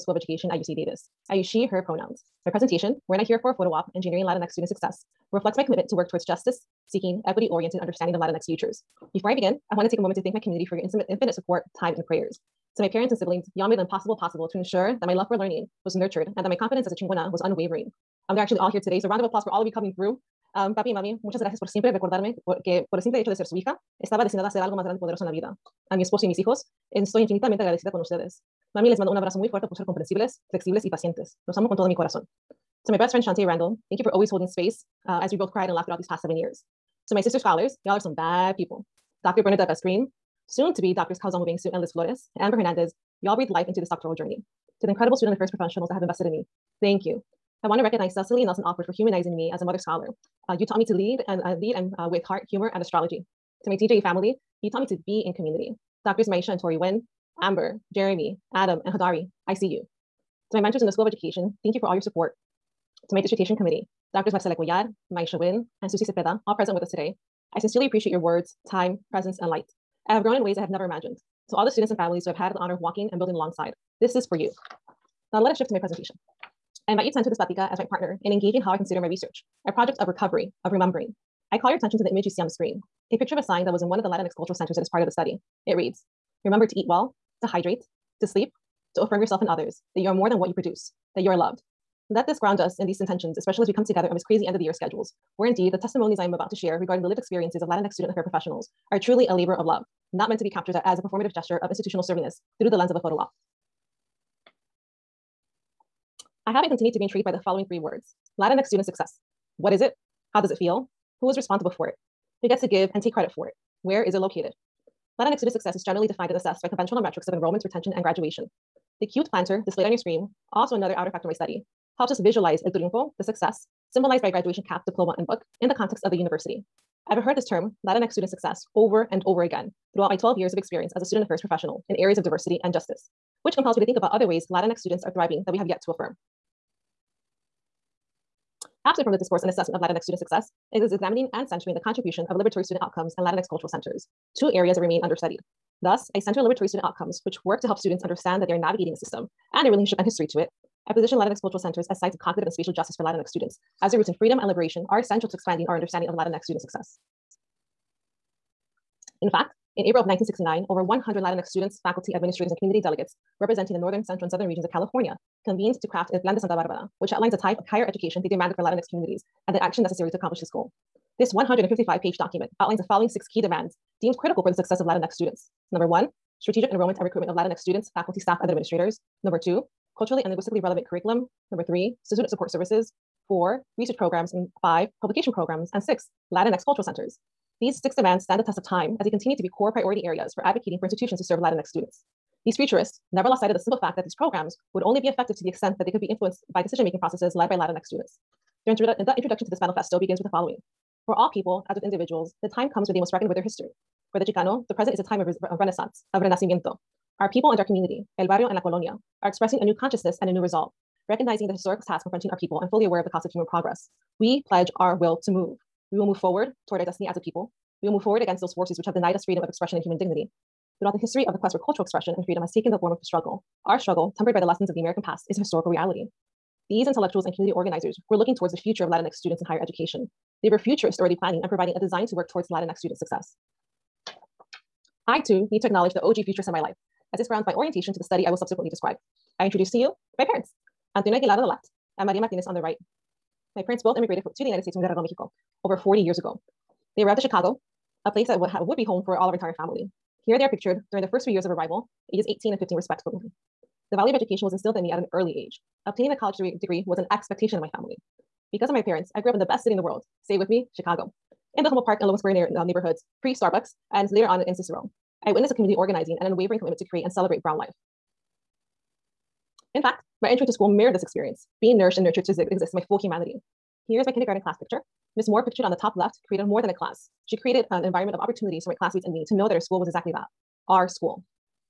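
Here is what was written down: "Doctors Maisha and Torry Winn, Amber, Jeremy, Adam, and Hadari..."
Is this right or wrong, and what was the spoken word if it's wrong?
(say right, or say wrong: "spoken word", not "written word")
right.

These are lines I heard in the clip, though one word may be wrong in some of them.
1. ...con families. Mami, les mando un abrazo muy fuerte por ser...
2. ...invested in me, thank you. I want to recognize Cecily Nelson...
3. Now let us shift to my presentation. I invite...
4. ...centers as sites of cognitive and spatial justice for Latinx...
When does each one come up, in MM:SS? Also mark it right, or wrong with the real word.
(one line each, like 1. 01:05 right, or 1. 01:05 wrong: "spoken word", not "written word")
1. 00:27 wrong: "ustedes", not "families"
2. 00:46 right
3. 01:15 right
4. 02:31 right.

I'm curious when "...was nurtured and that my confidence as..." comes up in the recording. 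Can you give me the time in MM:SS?
00:15.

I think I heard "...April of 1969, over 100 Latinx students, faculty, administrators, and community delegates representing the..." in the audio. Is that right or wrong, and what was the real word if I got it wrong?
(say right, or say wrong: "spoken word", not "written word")
right.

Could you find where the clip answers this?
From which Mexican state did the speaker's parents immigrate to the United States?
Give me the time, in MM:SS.
04:04.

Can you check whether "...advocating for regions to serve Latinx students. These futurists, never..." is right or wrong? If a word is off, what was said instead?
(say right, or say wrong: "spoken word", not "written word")
wrong: "institutions", not "regions".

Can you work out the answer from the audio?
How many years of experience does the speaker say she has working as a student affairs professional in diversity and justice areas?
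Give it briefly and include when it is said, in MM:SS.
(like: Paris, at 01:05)
12, at 02:10.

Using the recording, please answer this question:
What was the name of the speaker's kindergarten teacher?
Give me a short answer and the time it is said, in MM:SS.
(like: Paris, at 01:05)
Ms. Moore, at 04:35.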